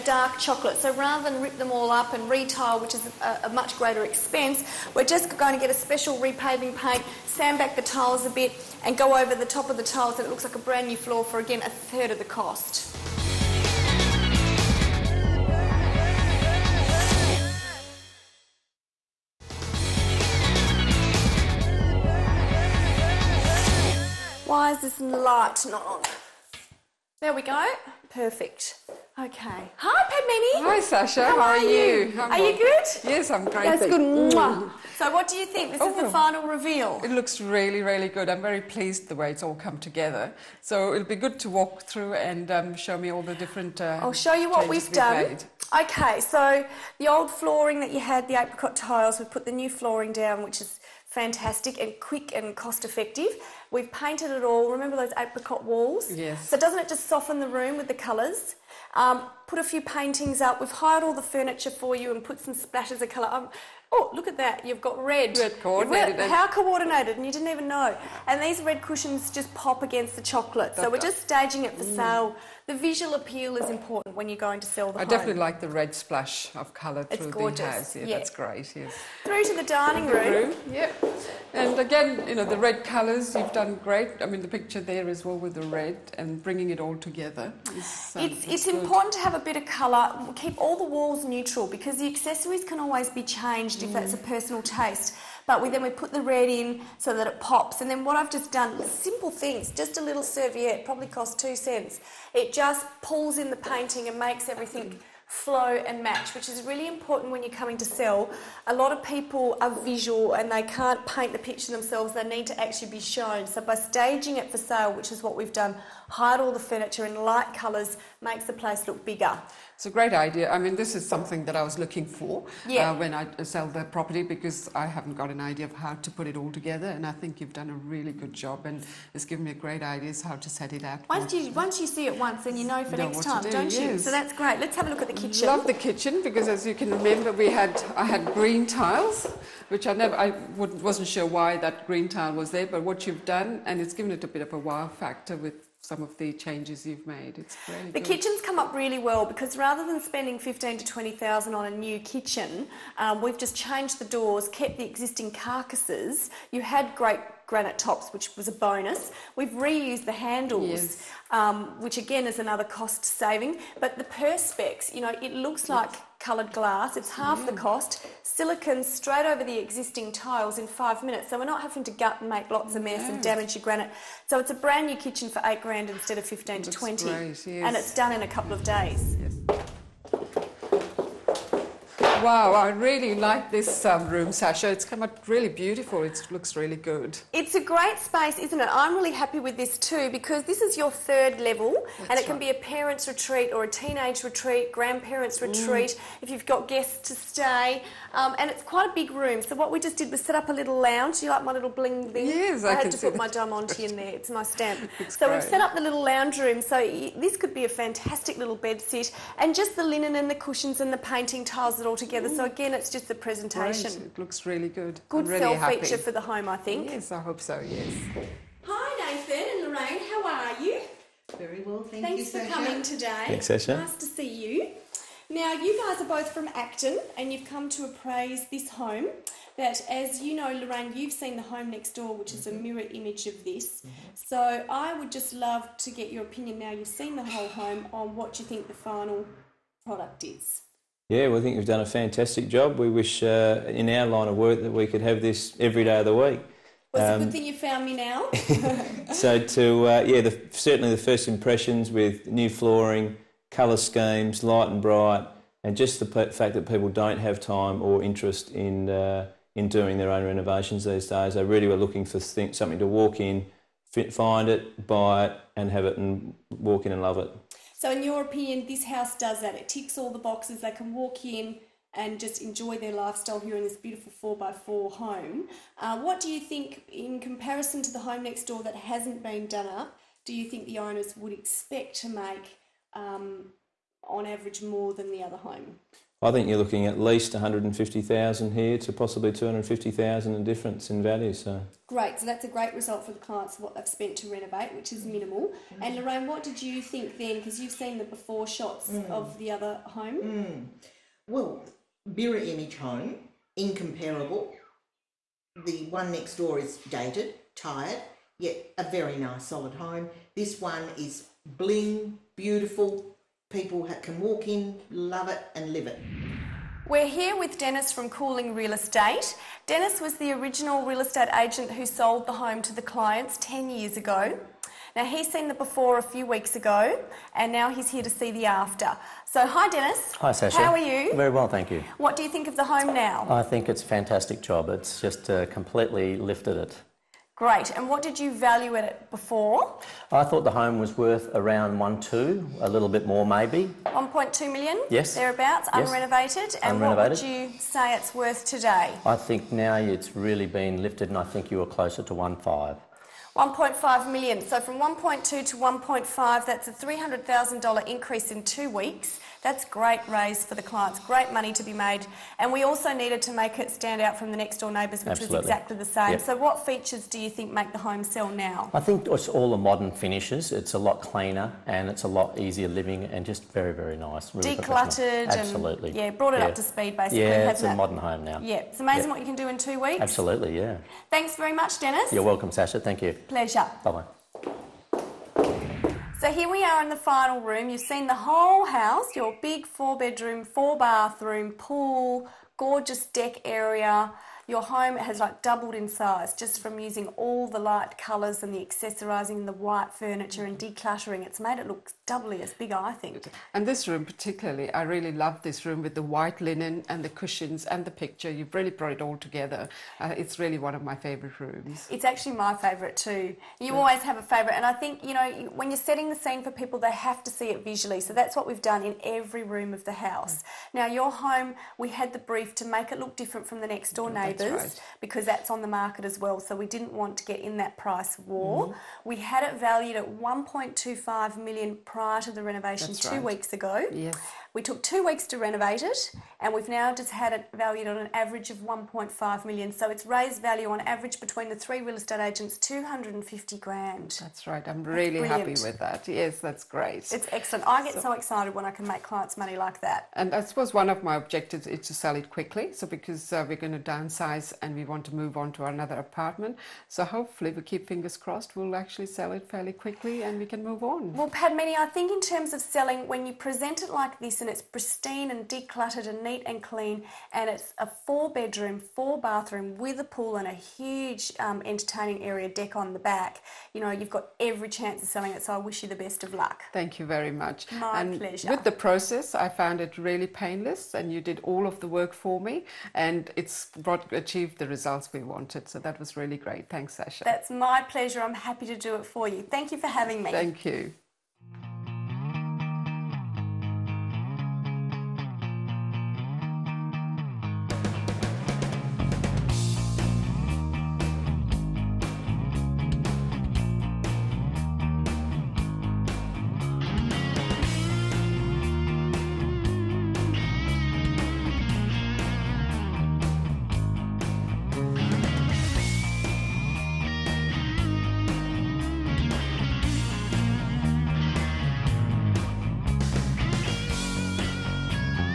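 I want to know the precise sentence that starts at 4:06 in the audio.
Well, it's um, a good thing you found me now.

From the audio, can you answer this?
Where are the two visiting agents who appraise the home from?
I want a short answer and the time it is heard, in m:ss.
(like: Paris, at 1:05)
Acton, at 3:46.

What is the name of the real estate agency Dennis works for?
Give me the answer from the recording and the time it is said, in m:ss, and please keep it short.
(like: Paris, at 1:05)
Cooling Real Estate, at 5:18.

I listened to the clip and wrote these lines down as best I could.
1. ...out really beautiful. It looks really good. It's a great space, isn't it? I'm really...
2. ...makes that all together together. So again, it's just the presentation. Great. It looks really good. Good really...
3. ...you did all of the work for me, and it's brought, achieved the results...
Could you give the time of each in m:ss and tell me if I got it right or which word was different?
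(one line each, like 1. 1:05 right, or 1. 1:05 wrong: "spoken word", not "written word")
1. 3:05 right
2. 3:31 wrong: "tiles", not "makes"
3. 8:01 right.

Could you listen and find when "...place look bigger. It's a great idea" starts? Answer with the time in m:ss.
1:58.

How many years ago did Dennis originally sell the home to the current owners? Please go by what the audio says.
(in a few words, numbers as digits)
10 years.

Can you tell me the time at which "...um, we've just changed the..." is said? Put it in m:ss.
2:32.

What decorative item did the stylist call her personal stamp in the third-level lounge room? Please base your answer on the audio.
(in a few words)
Diamante.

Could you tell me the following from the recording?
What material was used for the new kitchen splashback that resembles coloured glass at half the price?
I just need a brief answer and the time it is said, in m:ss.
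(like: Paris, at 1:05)
Perspex, at 2:44.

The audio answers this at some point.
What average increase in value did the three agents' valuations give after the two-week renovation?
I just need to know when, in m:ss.
7:22.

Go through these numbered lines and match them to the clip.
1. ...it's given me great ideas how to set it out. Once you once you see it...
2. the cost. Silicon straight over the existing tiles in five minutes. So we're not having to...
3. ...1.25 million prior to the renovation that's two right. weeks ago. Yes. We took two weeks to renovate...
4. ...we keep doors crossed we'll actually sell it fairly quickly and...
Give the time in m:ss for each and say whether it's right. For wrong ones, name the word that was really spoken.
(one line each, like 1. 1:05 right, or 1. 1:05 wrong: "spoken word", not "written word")
1. 2:09 right
2. 2:47 right
3. 7:10 right
4. 7:37 wrong: "fingers", not "doors".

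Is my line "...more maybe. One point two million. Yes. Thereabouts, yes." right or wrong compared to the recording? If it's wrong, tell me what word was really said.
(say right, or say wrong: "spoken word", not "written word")
right.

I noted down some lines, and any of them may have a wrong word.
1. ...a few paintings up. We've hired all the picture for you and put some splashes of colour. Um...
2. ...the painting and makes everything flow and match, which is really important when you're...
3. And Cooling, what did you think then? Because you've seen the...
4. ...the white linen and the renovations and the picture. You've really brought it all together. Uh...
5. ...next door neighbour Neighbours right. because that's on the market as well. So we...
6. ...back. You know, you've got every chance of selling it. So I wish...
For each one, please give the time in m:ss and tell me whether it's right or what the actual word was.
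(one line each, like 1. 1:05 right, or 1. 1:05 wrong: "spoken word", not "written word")
1. 0:59 wrong: "furniture", not "picture"
2. 1:43 right
3. 4:55 wrong: "Lorraine", not "Cooling"
4. 6:45 wrong: "cushions", not "renovations"
5. 7:03 right
6. 7:52 right.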